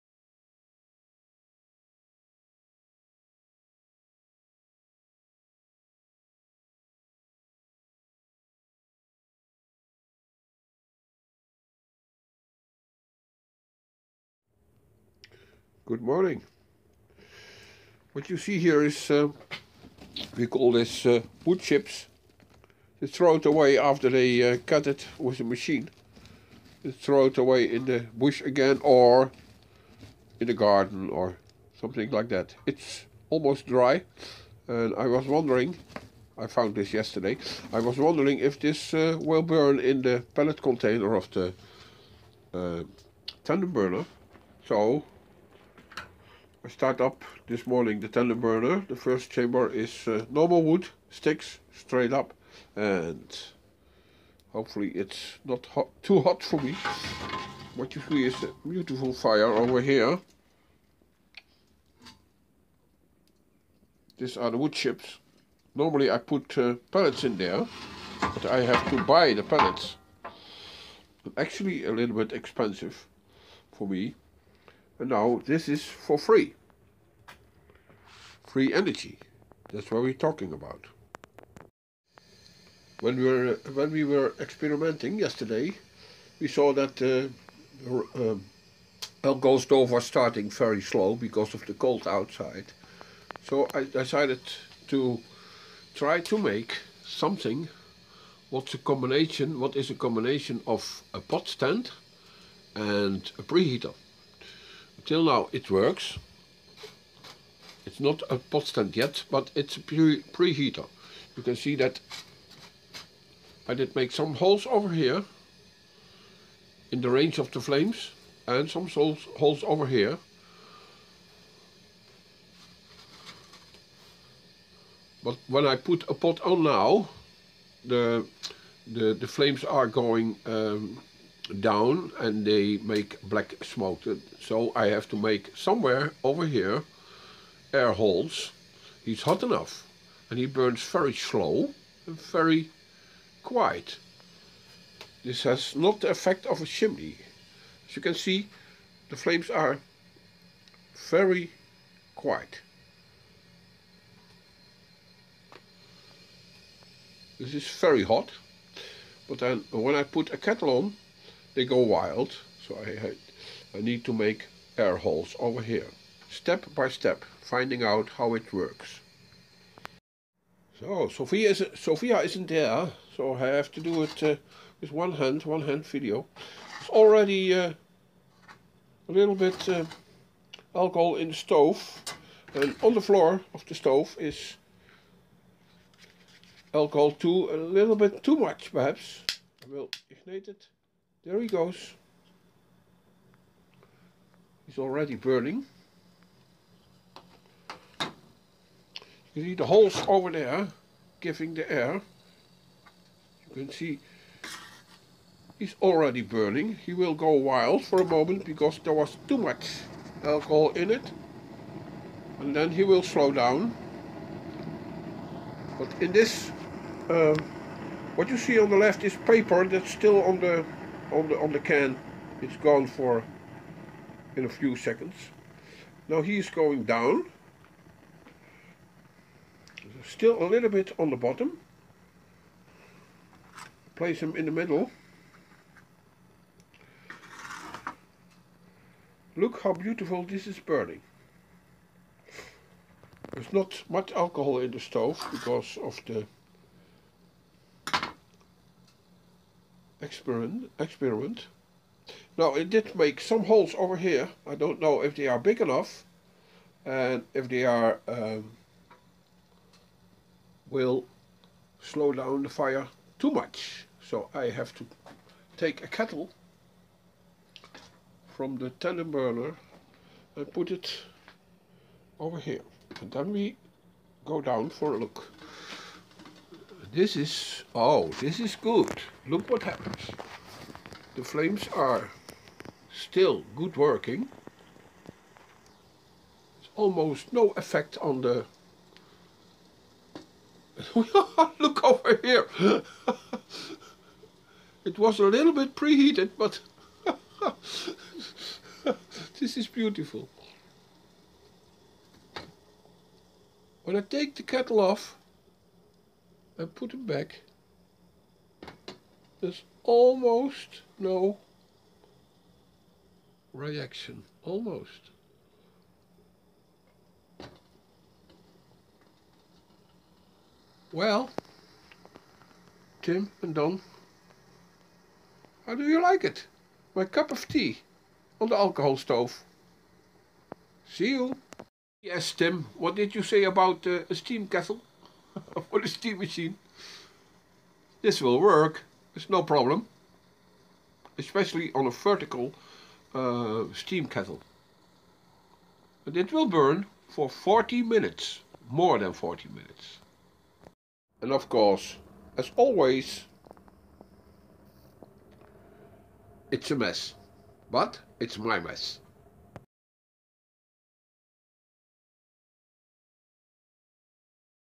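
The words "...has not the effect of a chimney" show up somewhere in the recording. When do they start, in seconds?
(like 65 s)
145 s.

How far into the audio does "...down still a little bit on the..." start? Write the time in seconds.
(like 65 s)
226 s.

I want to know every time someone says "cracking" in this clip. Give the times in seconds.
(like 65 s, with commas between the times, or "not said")
not said.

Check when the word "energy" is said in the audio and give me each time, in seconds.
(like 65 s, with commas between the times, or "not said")
78 s.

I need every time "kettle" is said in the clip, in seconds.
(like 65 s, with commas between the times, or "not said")
160 s, 265 s, 304 s, 334 s, 344 s.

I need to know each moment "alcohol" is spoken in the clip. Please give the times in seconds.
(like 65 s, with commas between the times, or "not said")
180 s, 186 s, 210 s, 244 s, 328 s.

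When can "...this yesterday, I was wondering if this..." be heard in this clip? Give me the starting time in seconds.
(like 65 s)
36 s.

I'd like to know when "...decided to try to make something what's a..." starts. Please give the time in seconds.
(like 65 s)
93 s.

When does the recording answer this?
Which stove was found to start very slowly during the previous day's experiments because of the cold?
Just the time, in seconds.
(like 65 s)
89 s.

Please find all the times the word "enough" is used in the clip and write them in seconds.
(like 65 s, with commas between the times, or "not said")
139 s, 255 s.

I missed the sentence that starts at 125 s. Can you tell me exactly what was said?
But when I put a pot on now, the the, the flames are going um, down and they make black smoke.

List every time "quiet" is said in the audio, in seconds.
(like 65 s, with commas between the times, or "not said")
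143 s, 152 s.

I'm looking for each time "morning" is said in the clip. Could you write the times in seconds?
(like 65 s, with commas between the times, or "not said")
16 s, 47 s.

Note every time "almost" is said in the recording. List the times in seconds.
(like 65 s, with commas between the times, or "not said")
33 s, 286 s, 309 s, 314 s.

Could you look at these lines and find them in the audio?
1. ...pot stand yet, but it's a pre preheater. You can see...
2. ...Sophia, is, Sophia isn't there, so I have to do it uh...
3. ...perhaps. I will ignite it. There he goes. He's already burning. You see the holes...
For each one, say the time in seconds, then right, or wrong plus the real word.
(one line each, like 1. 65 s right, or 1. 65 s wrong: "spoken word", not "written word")
1. 108 s right
2. 171 s right
3. 188 s right.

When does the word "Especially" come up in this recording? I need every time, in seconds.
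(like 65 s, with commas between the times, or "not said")
341 s.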